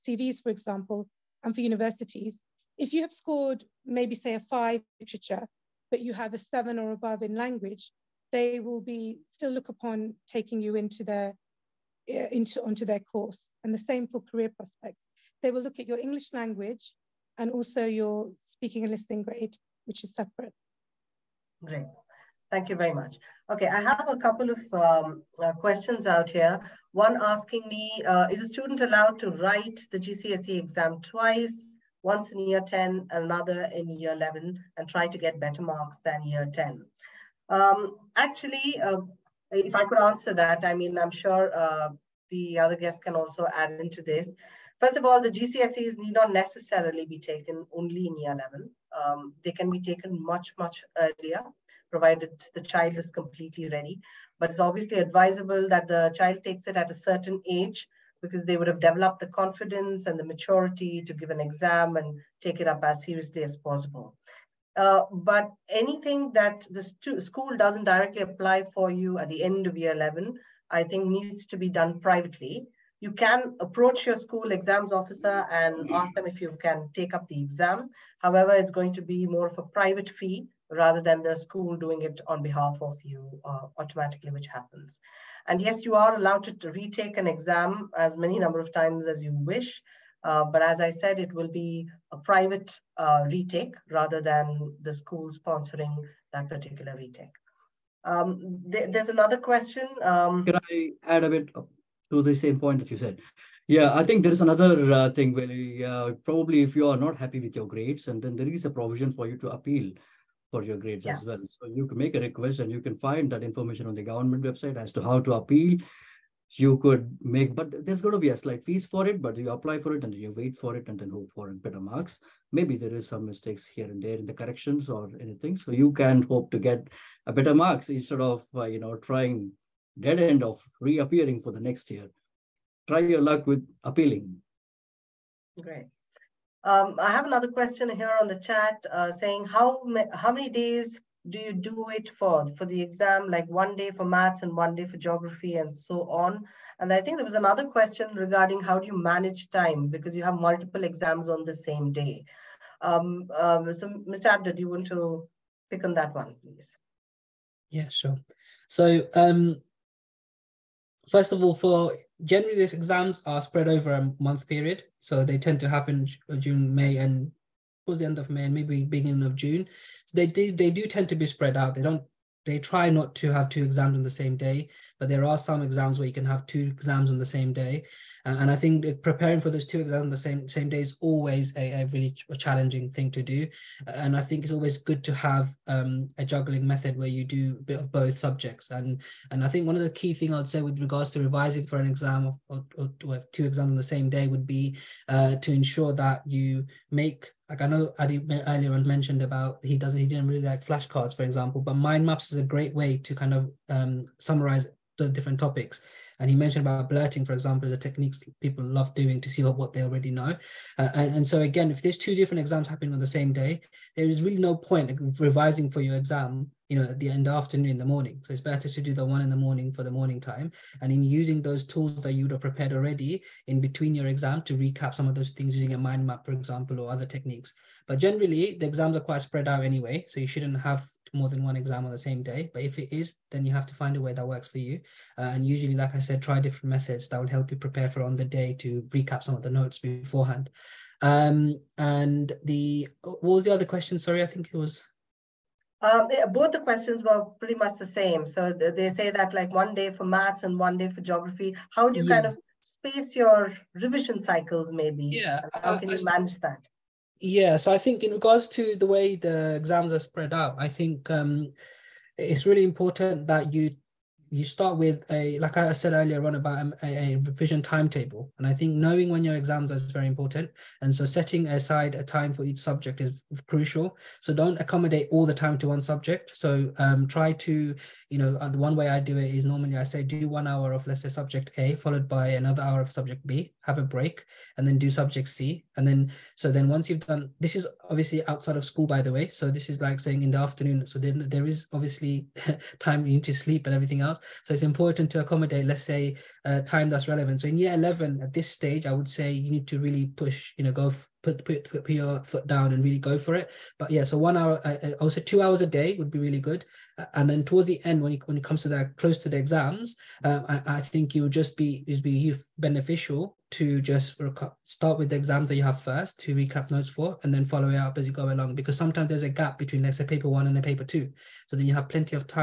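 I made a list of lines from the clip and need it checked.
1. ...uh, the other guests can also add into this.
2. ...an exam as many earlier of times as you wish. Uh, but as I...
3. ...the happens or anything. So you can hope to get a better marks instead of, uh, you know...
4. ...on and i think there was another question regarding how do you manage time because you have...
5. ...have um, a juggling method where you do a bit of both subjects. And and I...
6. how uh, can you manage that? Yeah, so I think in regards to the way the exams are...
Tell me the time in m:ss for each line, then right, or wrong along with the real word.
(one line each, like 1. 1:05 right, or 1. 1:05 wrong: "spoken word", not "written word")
1. 0:41 right
2. 1:27 wrong: "number", not "earlier"
3. 2:04 wrong: "corrections", not "happens"
4. 2:26 right
5. 3:05 right
6. 4:15 right.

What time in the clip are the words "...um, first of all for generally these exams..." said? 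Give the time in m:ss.
2:39.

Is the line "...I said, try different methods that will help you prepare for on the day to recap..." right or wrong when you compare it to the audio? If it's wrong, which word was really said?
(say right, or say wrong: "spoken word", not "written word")
right.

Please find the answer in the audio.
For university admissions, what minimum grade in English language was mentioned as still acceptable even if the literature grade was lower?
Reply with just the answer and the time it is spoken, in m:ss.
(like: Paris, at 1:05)
7, at 0:06.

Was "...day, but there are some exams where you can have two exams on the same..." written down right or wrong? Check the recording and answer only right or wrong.
right.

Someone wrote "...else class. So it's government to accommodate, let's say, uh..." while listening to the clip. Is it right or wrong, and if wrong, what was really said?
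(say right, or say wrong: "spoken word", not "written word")
wrong: "important", not "government".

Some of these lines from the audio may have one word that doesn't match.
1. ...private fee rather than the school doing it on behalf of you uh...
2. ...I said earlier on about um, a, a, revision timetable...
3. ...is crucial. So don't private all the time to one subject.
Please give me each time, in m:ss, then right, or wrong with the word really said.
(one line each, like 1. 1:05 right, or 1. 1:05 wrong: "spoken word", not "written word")
1. 1:19 right
2. 4:25 right
3. 4:33 wrong: "accommodate", not "private".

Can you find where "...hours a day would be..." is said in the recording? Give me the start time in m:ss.
5:05.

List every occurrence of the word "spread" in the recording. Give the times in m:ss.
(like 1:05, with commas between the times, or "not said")
2:43, 2:51, 3:49, 4:19.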